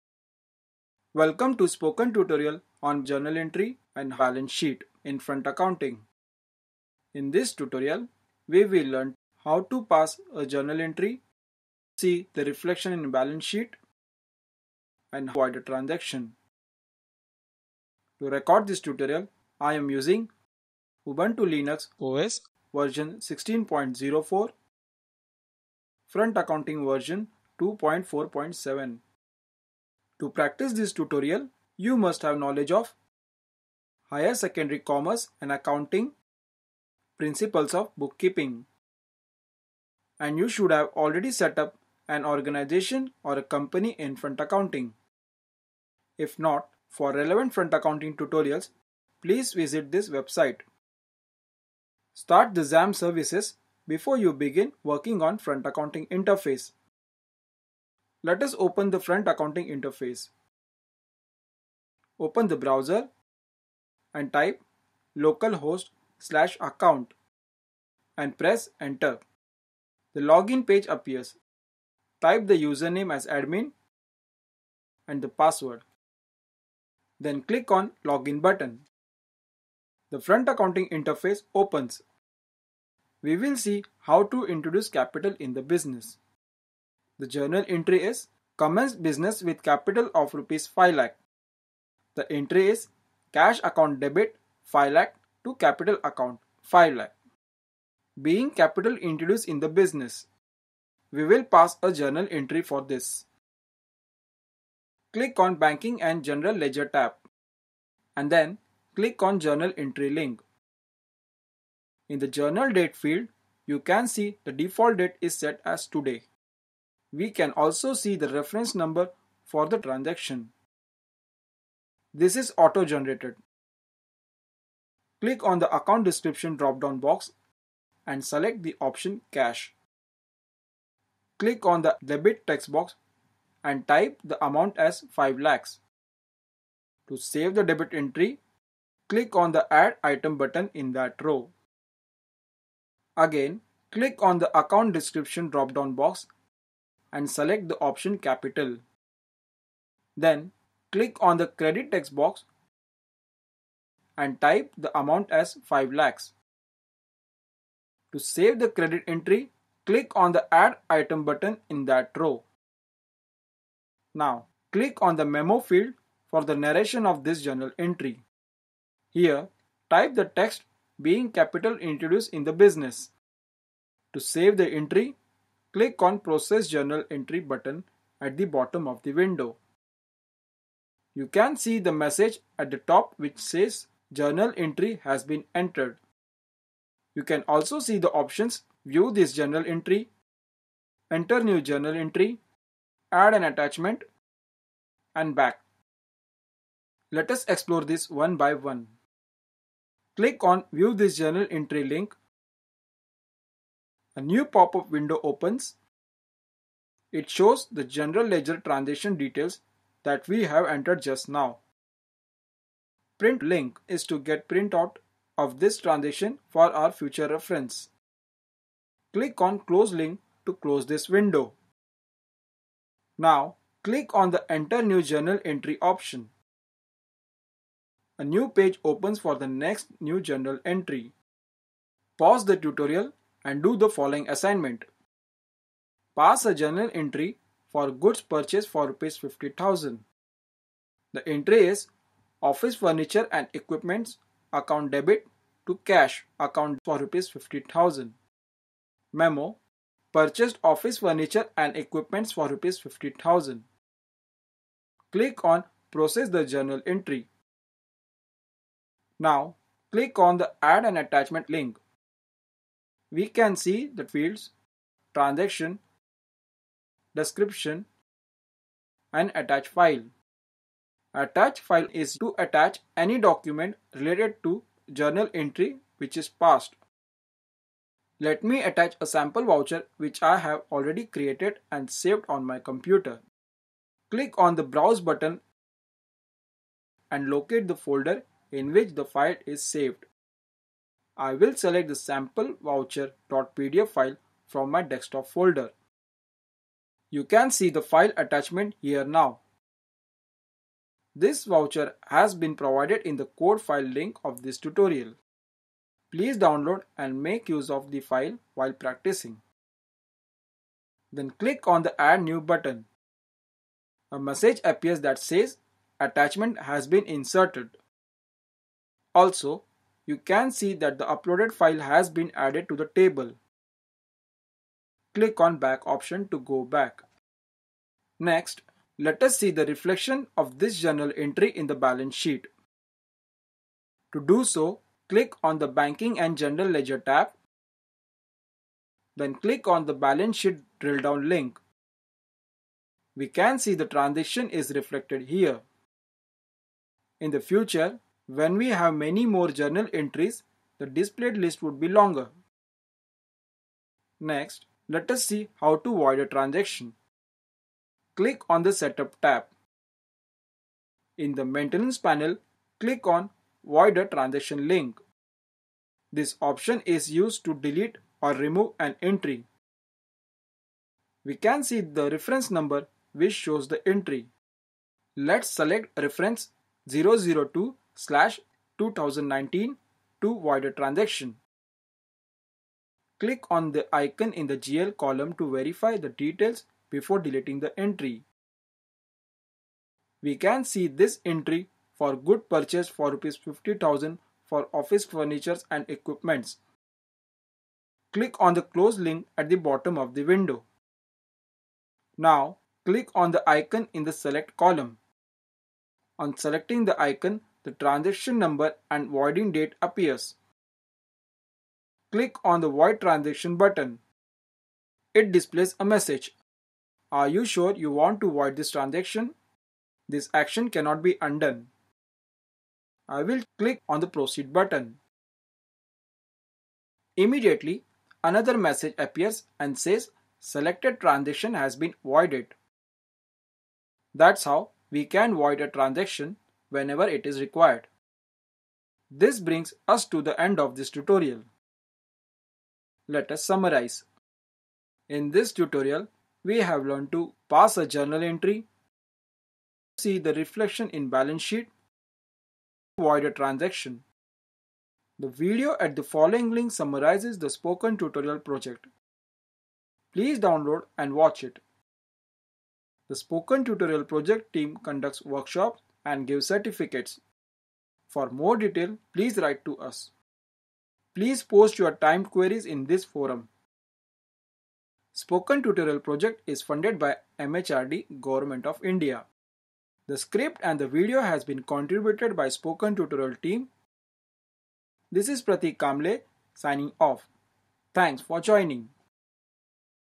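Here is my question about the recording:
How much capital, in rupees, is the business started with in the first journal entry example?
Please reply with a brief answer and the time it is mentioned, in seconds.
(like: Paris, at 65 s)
5 lakh, at 90 s.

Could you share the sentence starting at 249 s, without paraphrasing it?
Memo purchased office furniture and equipments for rupees 50,000.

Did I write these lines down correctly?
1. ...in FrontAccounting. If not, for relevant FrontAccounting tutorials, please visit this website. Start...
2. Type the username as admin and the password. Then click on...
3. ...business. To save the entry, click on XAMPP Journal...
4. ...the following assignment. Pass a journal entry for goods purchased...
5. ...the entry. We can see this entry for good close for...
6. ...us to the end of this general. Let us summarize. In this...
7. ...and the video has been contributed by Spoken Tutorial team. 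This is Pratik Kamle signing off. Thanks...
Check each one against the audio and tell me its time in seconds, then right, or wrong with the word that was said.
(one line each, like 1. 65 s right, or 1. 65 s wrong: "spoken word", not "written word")
1. 43 s right
2. 72 s right
3. 172 s wrong: "Process", not "XAMPP"
4. 233 s right
5. 387 s wrong: "purchase", not "close"
6. 439 s wrong: "tutorial", not "general"
7. 480 s right.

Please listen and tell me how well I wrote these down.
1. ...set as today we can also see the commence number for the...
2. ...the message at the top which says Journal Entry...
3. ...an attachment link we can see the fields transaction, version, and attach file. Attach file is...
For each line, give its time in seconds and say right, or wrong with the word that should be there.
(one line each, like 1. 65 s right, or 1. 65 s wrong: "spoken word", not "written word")
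1. 115 s wrong: "reference", not "commence"
2. 181 s right
3. 260 s wrong: "description", not "version".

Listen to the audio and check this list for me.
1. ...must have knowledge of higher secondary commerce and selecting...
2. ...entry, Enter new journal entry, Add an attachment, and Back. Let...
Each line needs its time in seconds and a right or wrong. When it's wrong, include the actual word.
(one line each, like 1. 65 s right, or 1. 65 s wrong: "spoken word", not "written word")
1. 31 s wrong: "accounting", not "selecting"
2. 189 s right.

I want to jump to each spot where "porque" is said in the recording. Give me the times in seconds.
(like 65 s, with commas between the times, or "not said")
not said.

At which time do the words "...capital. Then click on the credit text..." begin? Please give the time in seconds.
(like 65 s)
148 s.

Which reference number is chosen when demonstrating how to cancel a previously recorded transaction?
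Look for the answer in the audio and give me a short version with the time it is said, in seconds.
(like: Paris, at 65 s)
002/2019, at 376 s.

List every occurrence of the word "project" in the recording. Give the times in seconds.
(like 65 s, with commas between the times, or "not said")
458 s, 464 s, 475 s.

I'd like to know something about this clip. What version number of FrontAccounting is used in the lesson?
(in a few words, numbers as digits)
2.4.7.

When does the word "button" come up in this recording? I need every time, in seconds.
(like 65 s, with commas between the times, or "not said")
78 s, 140 s, 161 s, 177 s, 285 s, 312 s, 413 s, 424 s.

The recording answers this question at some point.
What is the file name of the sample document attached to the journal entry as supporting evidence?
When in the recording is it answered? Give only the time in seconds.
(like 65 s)
291 s.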